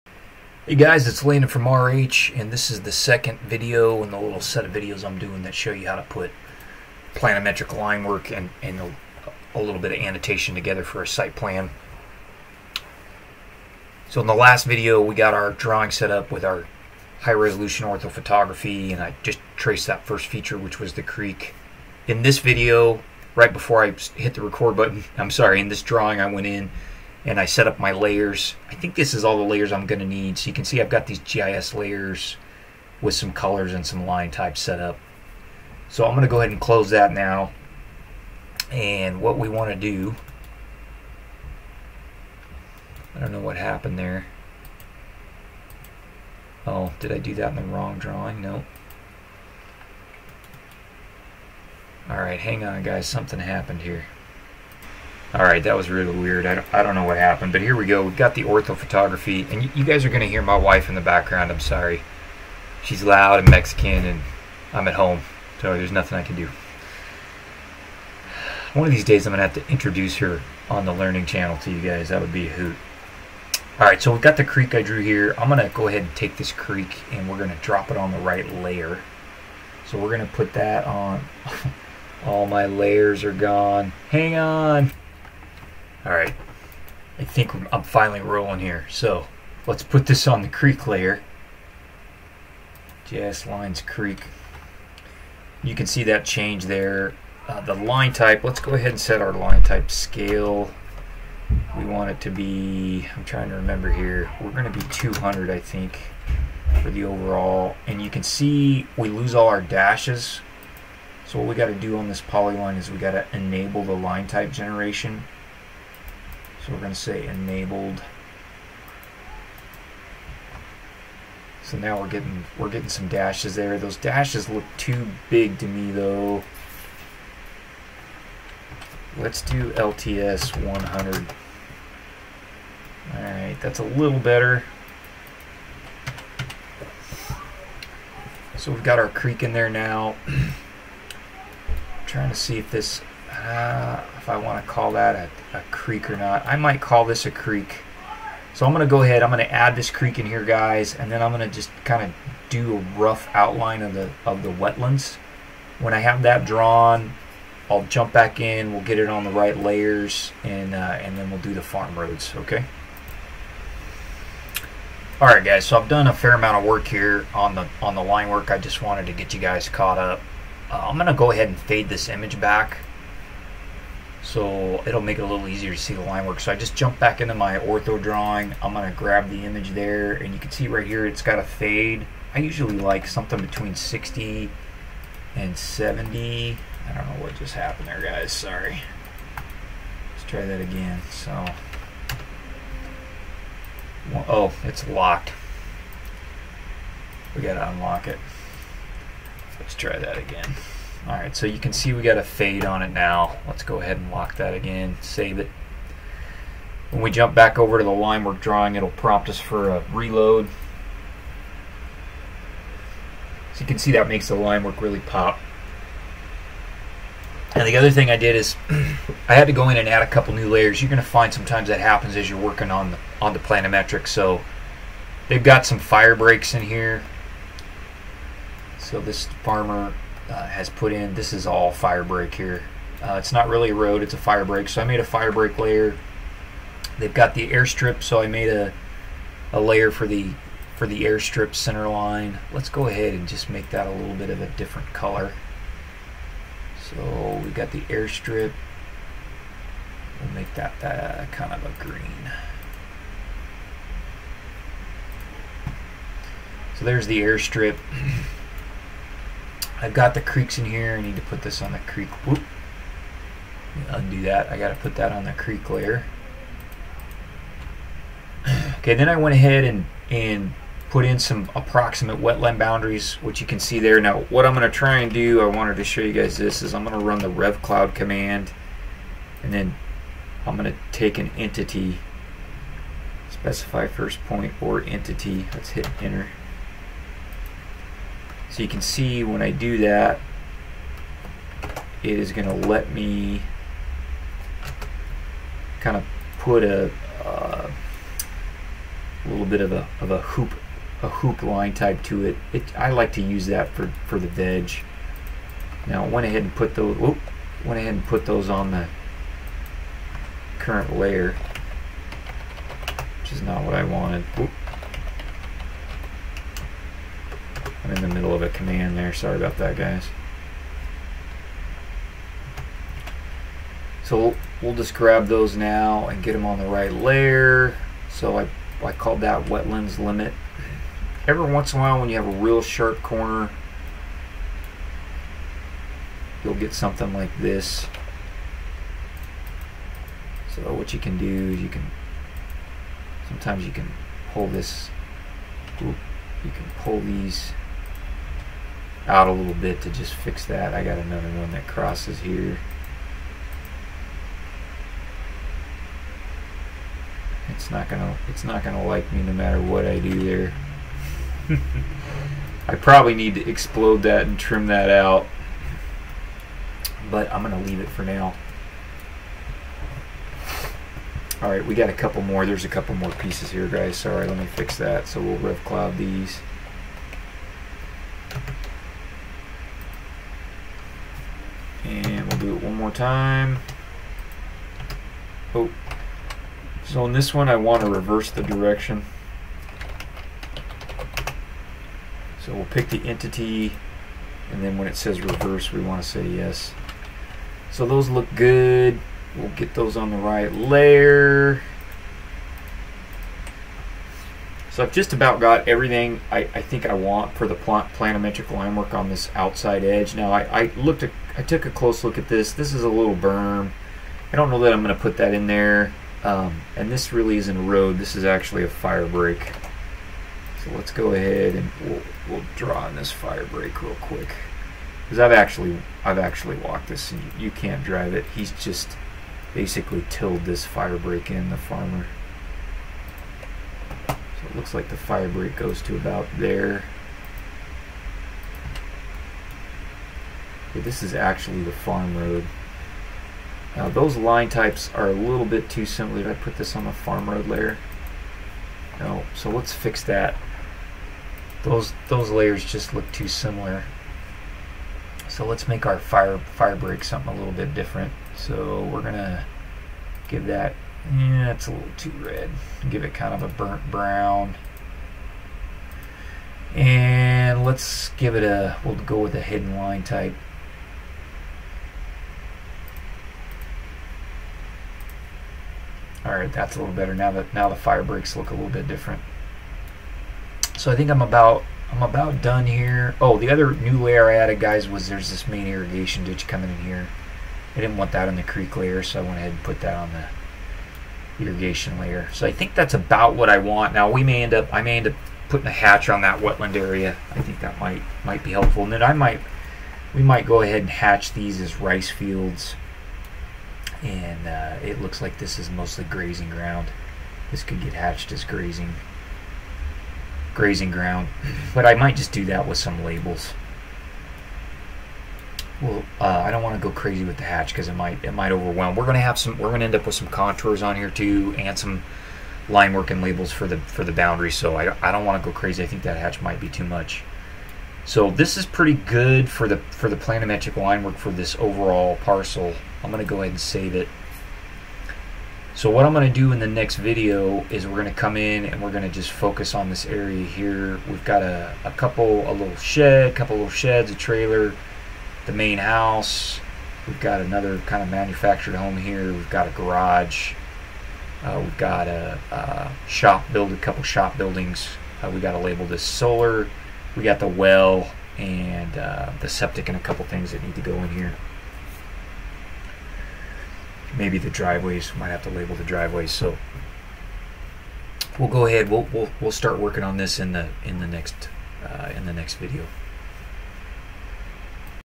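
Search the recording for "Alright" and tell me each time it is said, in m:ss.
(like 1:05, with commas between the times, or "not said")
0:55, 1:13, 2:13, 2:45, 6:11.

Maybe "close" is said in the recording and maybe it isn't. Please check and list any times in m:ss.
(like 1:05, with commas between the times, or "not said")
0:36, 6:51.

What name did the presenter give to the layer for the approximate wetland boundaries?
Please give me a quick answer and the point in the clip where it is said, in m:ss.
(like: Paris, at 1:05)
wetlands limit, at 5:29.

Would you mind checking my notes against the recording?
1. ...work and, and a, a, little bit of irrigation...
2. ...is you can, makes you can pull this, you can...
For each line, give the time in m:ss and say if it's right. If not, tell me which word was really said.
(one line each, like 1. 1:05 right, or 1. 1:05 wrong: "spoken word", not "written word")
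1. 0:08 wrong: "annotation", not "irrigation"
2. 5:41 wrong: "sometimes", not "makes".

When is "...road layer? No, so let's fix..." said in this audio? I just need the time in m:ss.
7:27.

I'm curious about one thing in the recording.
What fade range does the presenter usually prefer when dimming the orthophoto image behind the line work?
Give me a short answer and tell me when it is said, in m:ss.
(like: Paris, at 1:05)
60 to 70, at 3:03.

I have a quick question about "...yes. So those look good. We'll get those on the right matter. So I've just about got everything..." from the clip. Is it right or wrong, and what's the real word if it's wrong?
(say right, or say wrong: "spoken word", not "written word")
wrong: "layer", not "matter".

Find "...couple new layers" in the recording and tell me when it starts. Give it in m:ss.
3:40.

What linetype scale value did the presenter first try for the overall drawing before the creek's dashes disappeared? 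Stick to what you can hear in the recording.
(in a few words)
200.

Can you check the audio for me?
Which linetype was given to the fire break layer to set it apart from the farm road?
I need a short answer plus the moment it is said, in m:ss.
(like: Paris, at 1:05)
hidden, at 7:49.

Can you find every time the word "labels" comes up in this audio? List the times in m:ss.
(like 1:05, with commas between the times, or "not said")
8:33, 8:43, 9:15, 9:25.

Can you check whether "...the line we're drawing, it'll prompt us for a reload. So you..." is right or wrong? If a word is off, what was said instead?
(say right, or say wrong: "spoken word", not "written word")
right.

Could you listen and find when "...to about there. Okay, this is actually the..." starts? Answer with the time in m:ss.
7:15.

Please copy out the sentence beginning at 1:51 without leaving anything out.
So what we got to do on this polyline is we got to enable the line type generation.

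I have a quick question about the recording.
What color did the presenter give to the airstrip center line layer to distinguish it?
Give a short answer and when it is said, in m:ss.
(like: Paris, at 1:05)
green, at 4:11.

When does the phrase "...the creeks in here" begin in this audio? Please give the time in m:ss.
4:20.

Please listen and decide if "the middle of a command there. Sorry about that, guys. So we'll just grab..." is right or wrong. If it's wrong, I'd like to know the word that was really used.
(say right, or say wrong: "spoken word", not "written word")
right.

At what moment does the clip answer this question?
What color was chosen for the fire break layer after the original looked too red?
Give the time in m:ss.
7:43.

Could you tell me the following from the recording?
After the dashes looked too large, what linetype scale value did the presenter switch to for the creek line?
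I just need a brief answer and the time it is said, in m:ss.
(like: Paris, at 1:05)
100, at 2:09.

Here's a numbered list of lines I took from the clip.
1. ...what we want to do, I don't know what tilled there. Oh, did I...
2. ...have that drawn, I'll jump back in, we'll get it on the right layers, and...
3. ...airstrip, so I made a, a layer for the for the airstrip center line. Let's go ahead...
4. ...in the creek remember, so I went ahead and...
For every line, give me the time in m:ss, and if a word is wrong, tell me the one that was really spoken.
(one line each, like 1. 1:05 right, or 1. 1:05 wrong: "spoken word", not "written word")
1. 0:39 wrong: "happened", not "tilled"
2. 2:35 right
3. 3:57 right
4. 8:08 wrong: "layer", not "remember".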